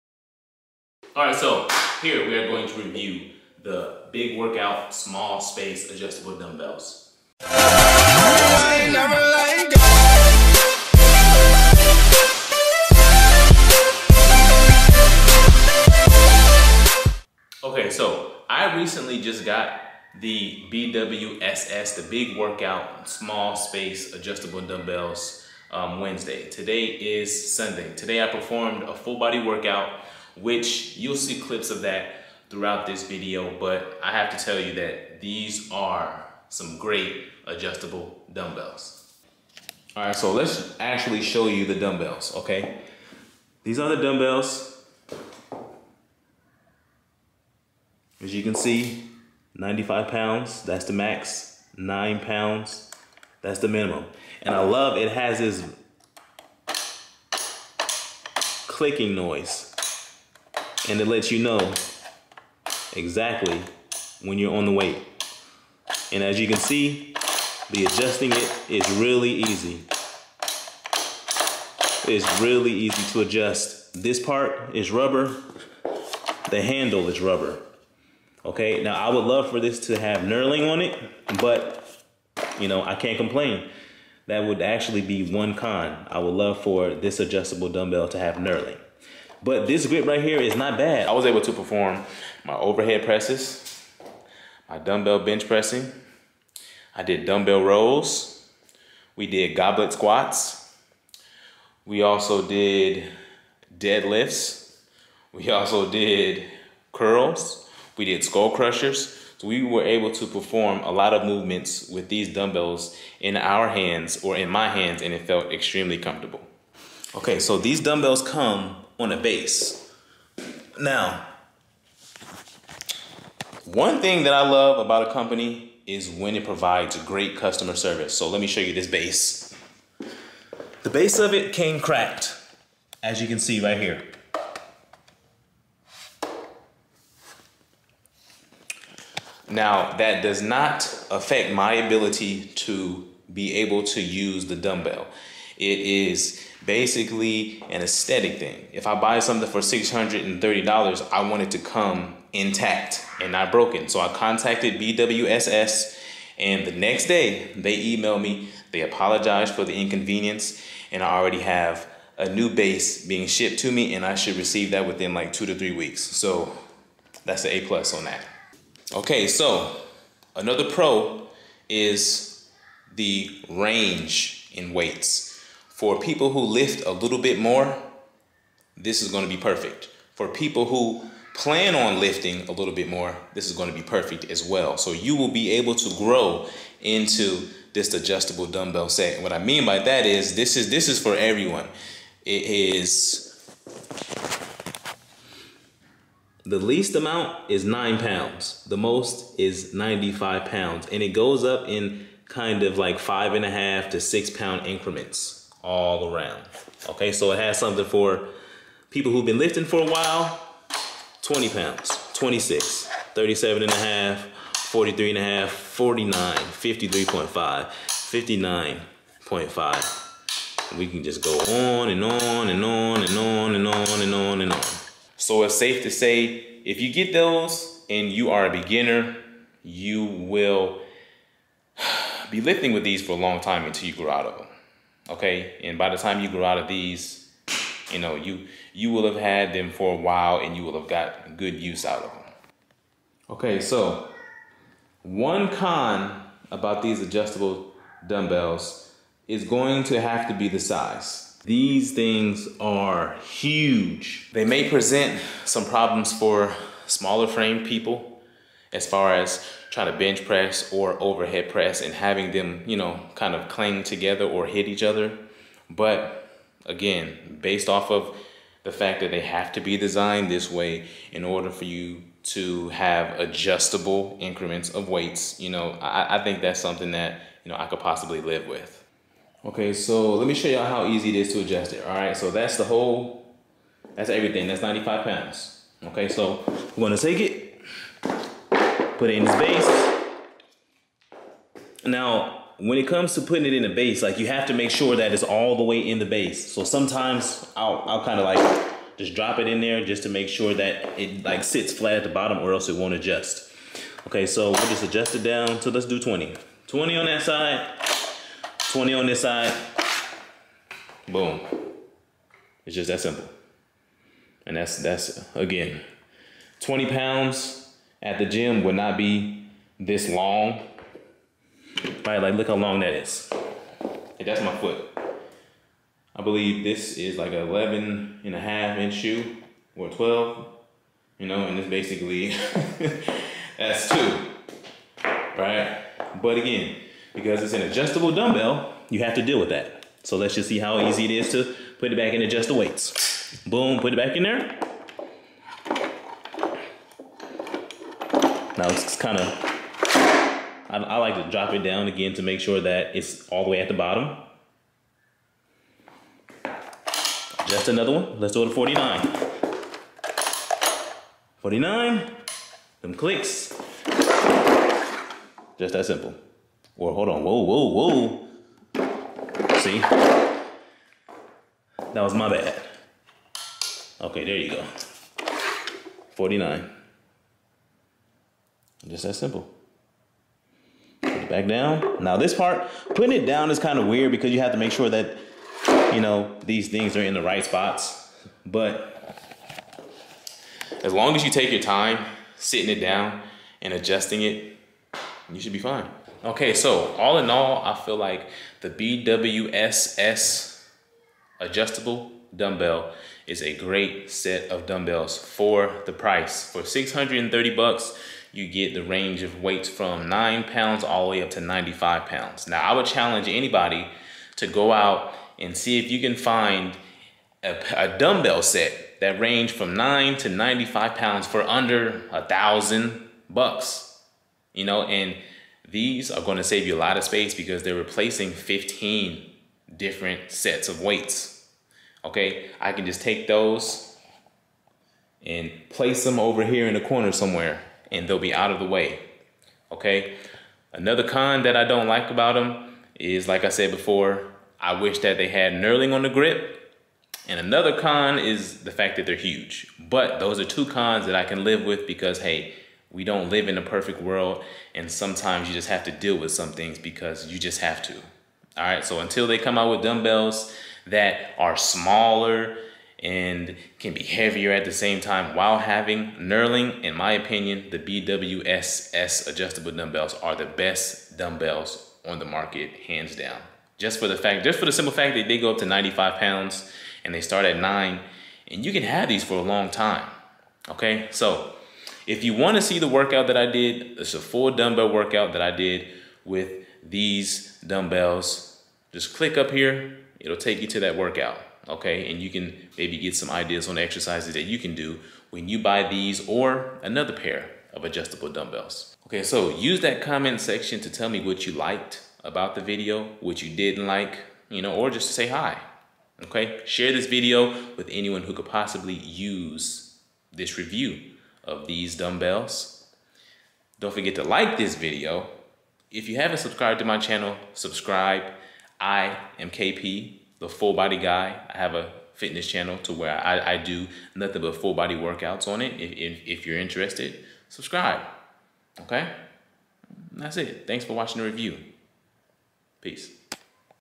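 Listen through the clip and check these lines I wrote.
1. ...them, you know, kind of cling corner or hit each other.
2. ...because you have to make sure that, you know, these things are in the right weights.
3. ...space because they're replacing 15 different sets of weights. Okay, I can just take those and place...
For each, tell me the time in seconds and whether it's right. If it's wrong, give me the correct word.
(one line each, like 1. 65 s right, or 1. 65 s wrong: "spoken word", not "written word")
1. 262 s wrong: "together", not "corner"
2. 384 s wrong: "spots", not "weights"
3. 427 s right.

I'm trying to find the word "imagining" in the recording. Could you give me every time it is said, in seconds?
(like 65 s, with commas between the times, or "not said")
not said.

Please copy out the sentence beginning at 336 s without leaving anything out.
But again, because it's an adjustable dumbbell, you have to deal with that.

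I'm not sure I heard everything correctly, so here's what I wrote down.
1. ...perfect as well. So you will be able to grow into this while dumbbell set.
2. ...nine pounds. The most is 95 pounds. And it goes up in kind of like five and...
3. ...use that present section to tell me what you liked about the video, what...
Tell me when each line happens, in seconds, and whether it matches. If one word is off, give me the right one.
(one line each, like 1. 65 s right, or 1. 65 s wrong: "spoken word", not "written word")
1. 183 s wrong: "adjustable", not "while"
2. 197 s right
3. 499 s wrong: "comment", not "present".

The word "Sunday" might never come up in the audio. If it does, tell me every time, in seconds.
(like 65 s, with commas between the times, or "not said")
27 s.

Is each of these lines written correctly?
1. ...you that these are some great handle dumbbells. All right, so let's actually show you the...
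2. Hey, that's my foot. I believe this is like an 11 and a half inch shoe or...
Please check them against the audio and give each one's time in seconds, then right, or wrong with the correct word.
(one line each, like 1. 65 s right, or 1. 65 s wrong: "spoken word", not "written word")
1. 34 s wrong: "adjustable", not "handle"
2. 324 s right.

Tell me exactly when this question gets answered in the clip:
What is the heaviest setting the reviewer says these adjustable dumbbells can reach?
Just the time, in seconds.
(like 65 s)
49 s.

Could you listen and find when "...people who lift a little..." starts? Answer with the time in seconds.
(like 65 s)
175 s.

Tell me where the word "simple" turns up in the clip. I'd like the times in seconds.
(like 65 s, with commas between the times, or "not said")
312 s, 365 s, 379 s, 474 s.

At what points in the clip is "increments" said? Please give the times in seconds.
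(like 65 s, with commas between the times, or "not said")
204 s, 274 s.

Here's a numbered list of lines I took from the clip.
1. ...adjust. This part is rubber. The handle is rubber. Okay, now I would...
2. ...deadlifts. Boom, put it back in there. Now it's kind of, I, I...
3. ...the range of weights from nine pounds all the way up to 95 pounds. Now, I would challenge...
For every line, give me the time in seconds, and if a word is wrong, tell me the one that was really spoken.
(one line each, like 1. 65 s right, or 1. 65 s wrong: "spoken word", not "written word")
1. 73 s right
2. 342 s wrong: "weights", not "deadlifts"
3. 408 s right.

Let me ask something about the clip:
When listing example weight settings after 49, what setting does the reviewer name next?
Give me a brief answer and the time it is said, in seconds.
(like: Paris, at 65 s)
53.5, at 216 s.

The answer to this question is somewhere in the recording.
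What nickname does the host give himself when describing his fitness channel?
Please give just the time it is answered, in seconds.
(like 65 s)
520 s.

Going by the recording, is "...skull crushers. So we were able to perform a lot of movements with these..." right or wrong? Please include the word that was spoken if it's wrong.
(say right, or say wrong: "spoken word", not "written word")
right.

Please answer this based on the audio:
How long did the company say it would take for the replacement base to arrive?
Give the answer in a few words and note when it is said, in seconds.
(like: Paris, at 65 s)
2 to 3 weeks, at 165 s.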